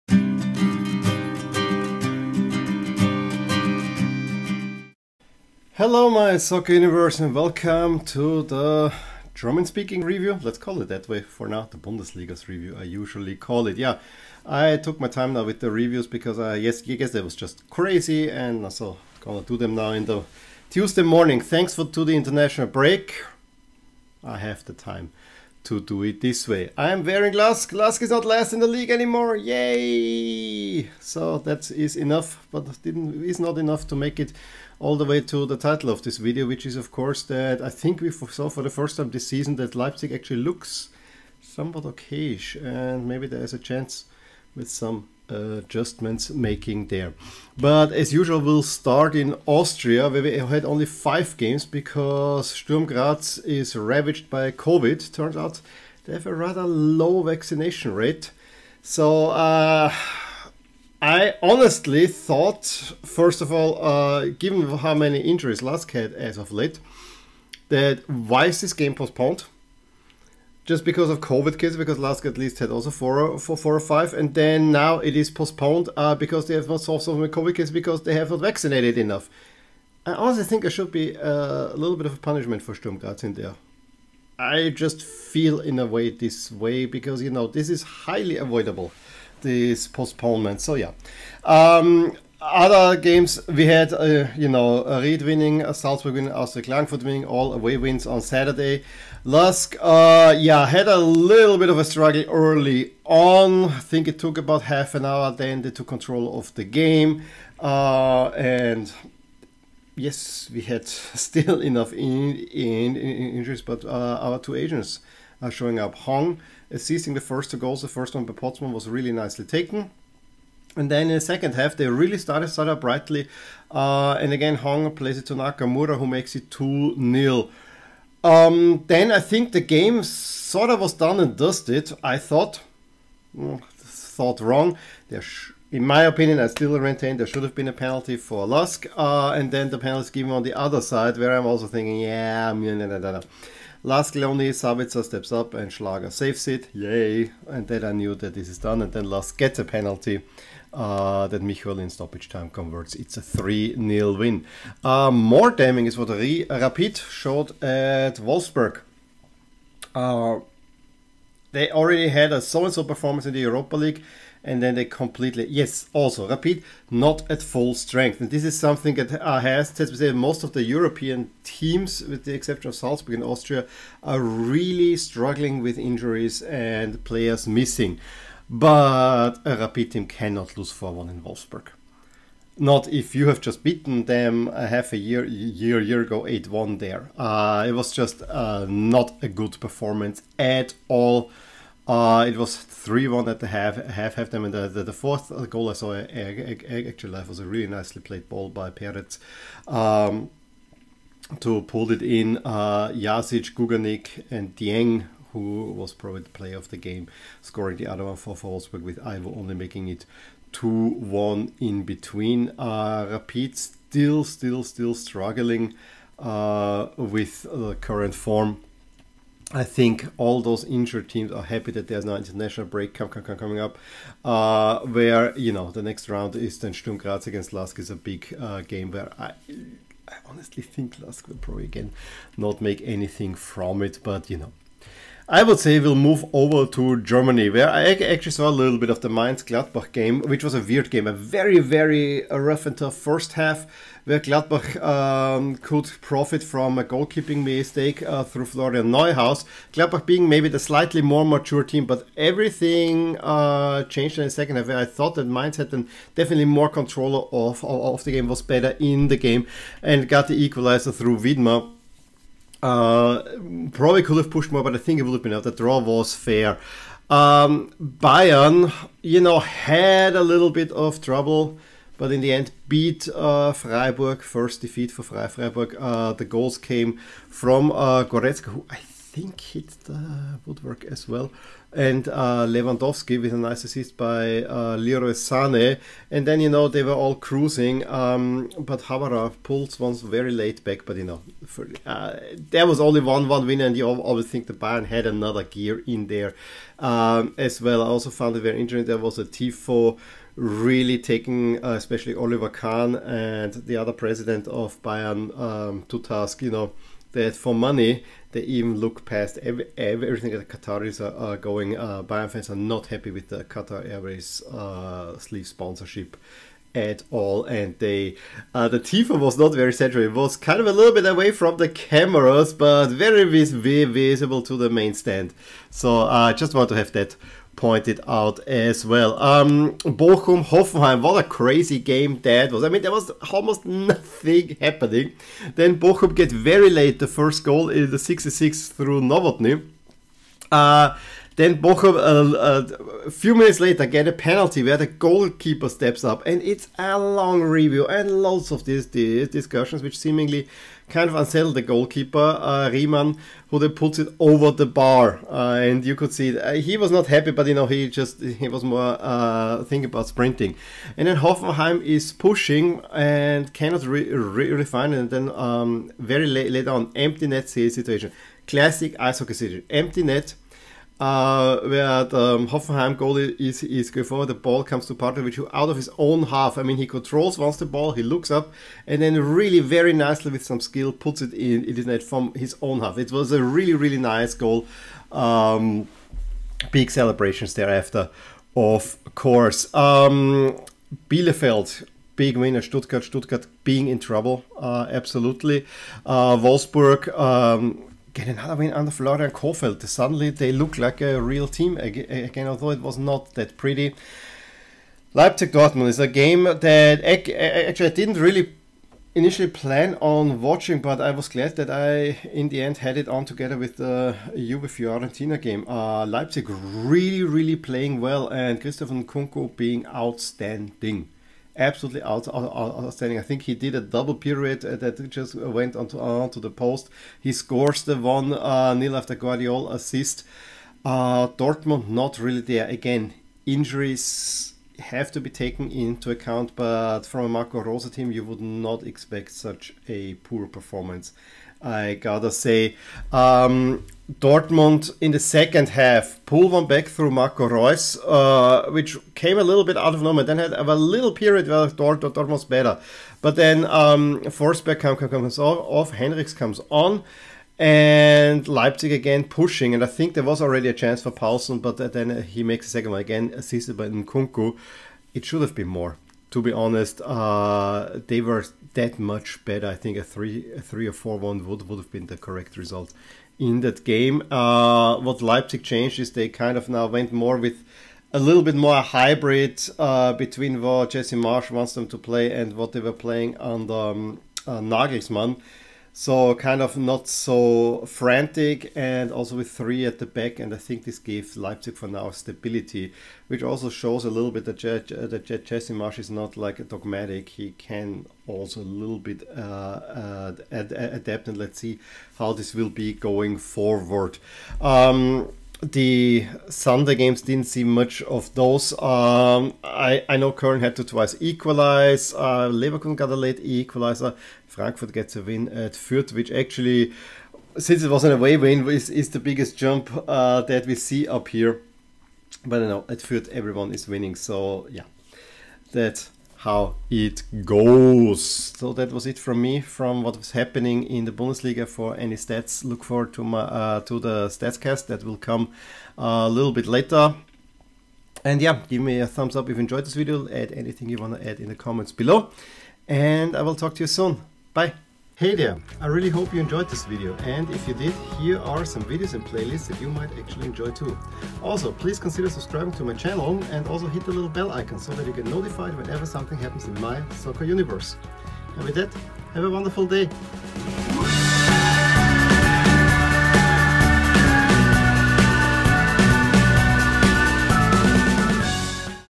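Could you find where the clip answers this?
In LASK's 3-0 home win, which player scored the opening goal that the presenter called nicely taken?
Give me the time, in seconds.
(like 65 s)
118 s.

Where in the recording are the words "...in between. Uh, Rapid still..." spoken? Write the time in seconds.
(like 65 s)
211 s.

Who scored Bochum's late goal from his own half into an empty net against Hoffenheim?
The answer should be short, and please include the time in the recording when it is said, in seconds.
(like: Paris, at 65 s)
Pantovic, at 374 s.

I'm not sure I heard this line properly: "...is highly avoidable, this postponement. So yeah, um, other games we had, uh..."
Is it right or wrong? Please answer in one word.
right.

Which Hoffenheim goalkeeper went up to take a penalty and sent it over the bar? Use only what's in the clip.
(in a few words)
Riemann.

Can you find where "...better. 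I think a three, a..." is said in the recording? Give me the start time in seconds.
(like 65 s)
469 s.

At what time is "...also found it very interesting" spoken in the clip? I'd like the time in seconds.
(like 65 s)
297 s.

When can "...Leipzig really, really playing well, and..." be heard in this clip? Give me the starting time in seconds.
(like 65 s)
416 s.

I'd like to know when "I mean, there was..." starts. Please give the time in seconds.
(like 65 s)
332 s.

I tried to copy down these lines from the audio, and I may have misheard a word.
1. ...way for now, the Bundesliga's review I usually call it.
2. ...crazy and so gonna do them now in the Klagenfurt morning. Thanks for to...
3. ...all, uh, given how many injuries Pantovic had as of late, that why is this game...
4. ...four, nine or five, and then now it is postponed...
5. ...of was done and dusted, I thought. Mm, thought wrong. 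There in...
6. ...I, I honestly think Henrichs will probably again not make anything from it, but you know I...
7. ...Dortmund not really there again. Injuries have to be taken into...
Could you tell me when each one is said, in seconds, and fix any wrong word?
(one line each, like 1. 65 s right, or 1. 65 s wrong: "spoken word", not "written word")
1. 11 s right
2. 17 s wrong: "Tuesday", not "Klagenfurt"
3. 63 s wrong: "Lask", not "Pantovic"
4. 73 s wrong: "four", not "nine"
5. 130 s right
6. 229 s wrong: "Lask", not "Henrichs"
7. 431 s right.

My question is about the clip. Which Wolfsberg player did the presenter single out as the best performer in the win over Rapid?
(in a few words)
Dieng.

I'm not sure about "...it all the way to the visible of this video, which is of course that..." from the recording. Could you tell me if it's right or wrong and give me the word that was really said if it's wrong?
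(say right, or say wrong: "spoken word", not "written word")
wrong: "title", not "visible".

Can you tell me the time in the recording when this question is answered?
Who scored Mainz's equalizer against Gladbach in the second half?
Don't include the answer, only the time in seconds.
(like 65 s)
261 s.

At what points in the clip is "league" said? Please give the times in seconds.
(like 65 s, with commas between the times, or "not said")
28 s, 163 s.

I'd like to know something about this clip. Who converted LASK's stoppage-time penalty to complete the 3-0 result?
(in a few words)
Michorl.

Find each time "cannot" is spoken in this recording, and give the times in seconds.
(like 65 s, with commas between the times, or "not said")
180 s, 363 s.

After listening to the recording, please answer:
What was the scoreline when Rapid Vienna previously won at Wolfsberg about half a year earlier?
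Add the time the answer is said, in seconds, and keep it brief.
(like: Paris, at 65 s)
8-1, at 186 s.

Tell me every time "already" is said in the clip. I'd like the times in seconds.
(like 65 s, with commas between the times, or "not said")
161 s, 460 s.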